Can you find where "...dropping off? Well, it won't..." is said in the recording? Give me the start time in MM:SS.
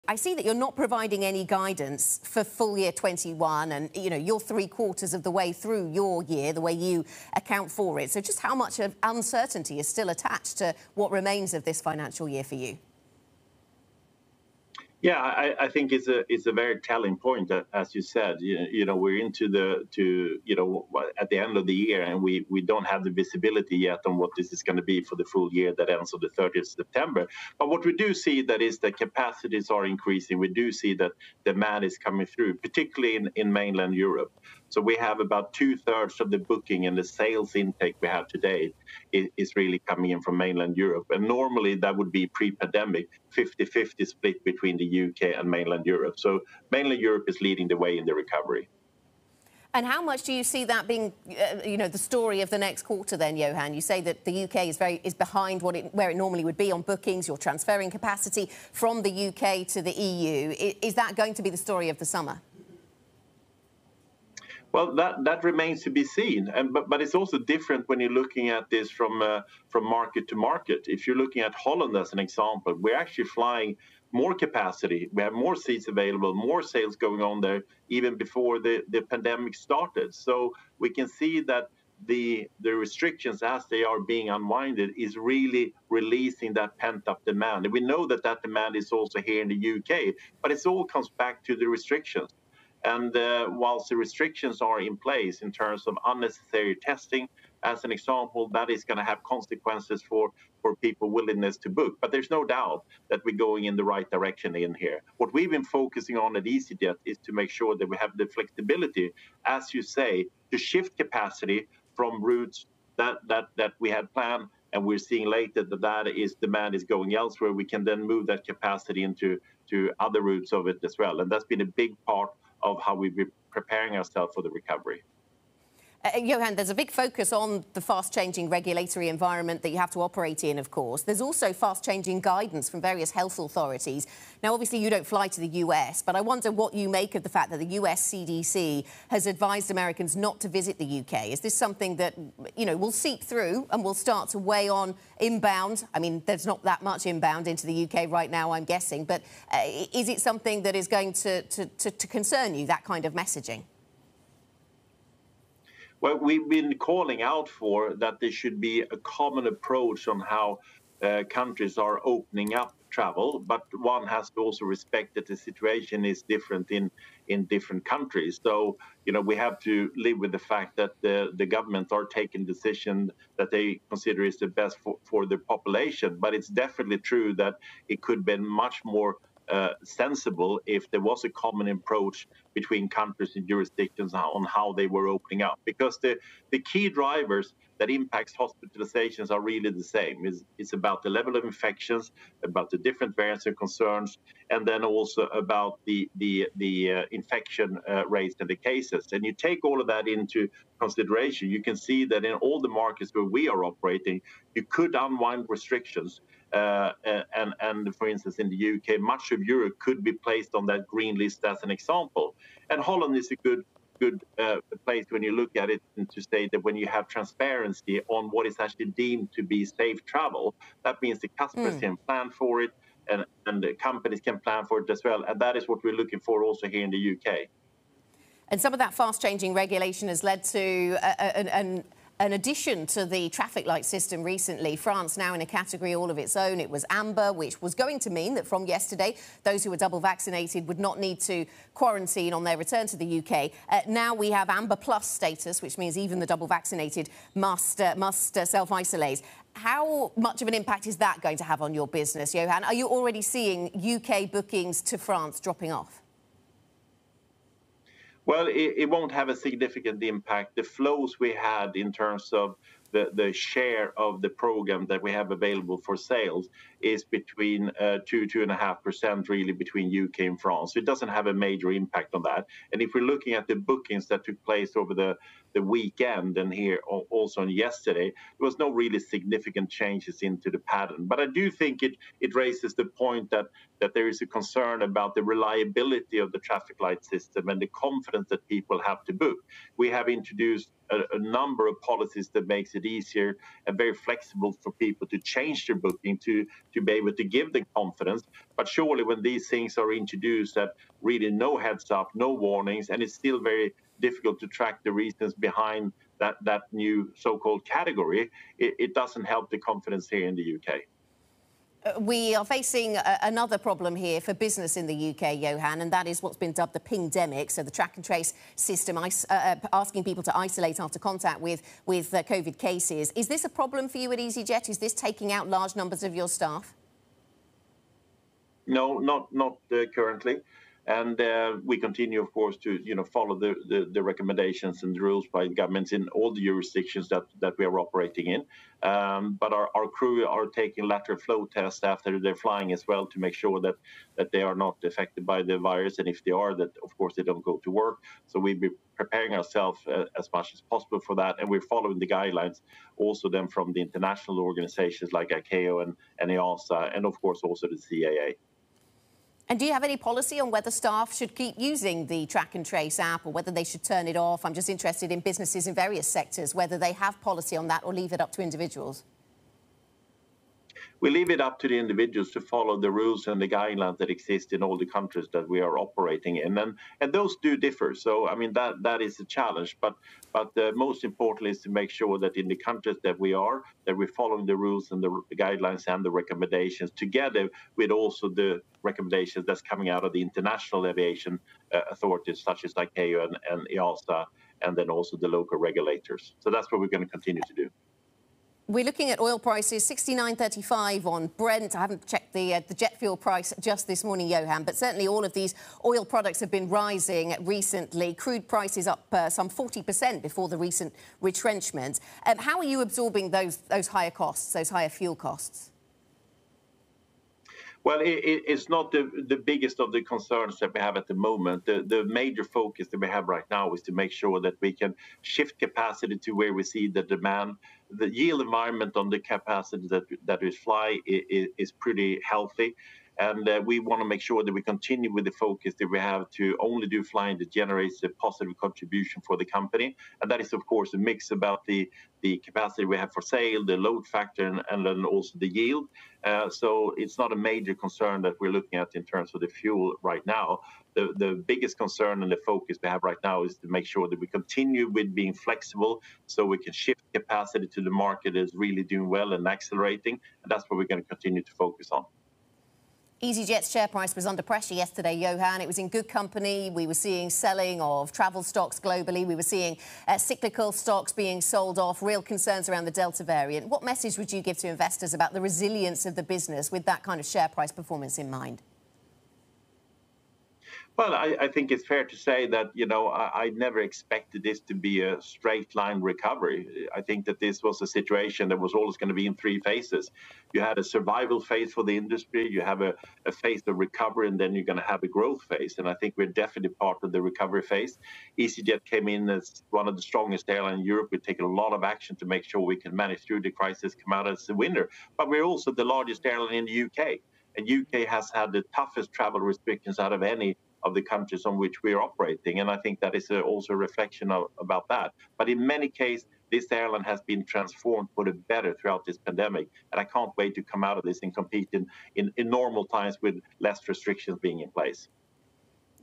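04:15.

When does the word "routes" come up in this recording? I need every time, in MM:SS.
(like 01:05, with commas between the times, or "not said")
01:52, 02:00.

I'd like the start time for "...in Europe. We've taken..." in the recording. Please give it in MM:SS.
08:20.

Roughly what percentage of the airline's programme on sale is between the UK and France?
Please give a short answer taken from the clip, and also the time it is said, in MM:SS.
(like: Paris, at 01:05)
25%, at 04:28.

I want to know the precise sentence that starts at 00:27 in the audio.
But what we do see that is that capacities are increasing.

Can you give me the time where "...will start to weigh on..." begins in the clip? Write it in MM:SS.
02:23.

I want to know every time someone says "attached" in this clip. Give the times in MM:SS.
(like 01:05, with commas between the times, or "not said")
00:10.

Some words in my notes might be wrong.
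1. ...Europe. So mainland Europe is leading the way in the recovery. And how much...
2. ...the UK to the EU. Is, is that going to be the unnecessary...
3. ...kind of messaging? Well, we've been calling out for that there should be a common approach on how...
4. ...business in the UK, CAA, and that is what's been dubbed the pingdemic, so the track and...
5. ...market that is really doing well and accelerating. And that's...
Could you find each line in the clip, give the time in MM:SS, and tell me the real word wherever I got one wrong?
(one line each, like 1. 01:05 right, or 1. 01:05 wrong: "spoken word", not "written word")
1. 00:45 right
2. 00:59 wrong: "story", not "unnecessary"
3. 02:32 right
4. 05:14 wrong: "Johan", not "CAA"
5. 07:37 right.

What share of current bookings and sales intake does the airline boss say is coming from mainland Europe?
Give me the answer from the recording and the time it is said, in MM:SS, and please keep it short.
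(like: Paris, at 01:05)
two-thirds, at 00:35.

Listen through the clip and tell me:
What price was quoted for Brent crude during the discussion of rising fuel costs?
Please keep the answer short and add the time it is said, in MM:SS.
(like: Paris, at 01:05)
69.35, at 06:39.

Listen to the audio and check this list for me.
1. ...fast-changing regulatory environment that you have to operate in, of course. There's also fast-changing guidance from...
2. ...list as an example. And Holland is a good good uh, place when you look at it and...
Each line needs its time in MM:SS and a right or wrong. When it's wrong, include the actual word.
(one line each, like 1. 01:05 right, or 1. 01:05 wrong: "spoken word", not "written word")
1. 02:07 right
2. 03:31 right.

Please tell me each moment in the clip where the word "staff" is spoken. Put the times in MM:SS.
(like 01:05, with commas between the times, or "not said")
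05:26, 06:00.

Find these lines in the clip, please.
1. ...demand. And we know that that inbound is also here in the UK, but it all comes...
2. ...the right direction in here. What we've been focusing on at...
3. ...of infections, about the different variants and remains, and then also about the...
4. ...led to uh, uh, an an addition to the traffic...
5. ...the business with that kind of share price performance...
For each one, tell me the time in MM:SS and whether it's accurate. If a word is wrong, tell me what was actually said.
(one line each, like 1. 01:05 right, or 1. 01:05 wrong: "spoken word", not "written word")
1. 01:27 wrong: "demand", not "inbound"
2. 01:43 right
3. 03:11 wrong: "concerns", not "remains"
4. 03:50 right
5. 07:56 right.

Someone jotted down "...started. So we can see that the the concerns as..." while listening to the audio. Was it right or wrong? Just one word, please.
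wrong.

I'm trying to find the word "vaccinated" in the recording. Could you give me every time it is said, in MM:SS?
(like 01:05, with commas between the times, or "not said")
03:59, 04:06.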